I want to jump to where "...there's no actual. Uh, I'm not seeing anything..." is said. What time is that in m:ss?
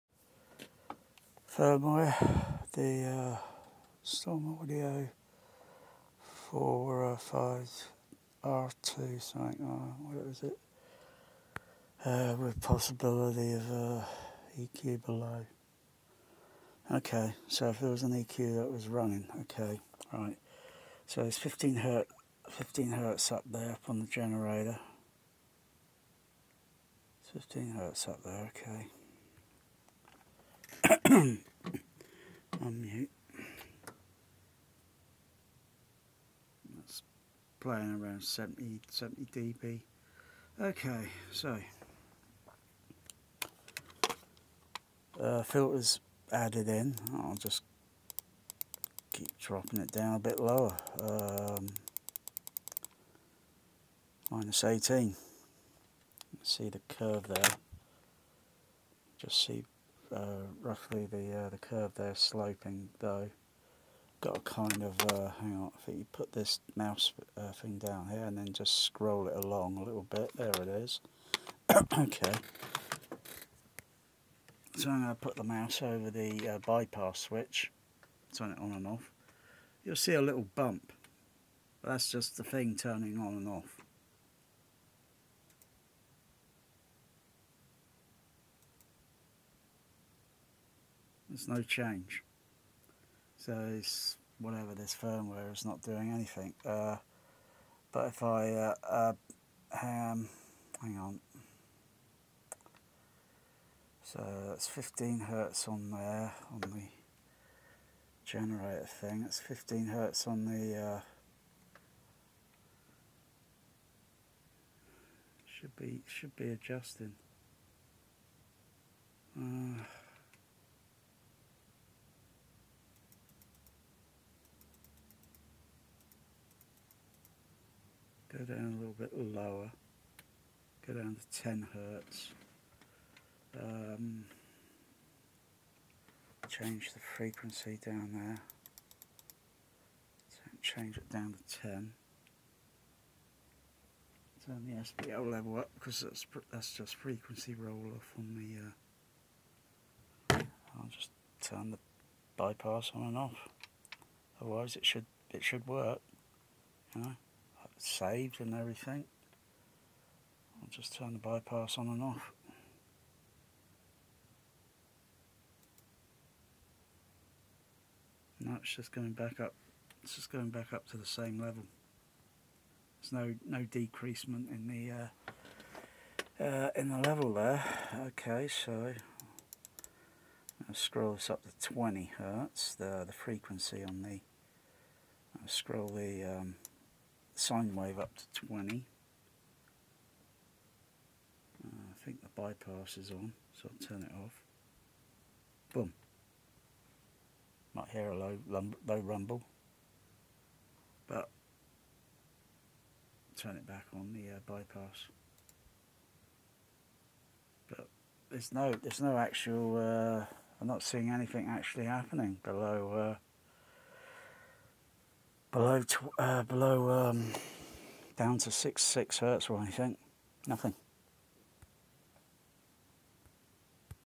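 3:28.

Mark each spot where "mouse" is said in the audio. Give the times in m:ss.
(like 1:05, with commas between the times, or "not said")
1:06, 1:15.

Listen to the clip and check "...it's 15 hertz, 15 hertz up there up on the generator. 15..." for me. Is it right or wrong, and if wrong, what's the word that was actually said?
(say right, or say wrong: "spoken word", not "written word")
right.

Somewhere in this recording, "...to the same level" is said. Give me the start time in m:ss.
2:50.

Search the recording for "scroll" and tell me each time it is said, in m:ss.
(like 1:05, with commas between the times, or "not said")
1:08, 3:00, 3:05.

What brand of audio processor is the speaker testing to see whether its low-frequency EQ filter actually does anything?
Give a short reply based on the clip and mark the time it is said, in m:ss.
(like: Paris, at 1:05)
Storm Audio, at 0:04.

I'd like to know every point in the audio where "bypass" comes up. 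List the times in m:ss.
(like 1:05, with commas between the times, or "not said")
1:16, 2:32, 2:41, 3:12, 3:24.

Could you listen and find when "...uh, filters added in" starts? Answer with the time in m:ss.
0:45.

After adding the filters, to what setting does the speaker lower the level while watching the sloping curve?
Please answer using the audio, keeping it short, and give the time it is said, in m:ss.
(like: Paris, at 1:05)
-18, at 0:54.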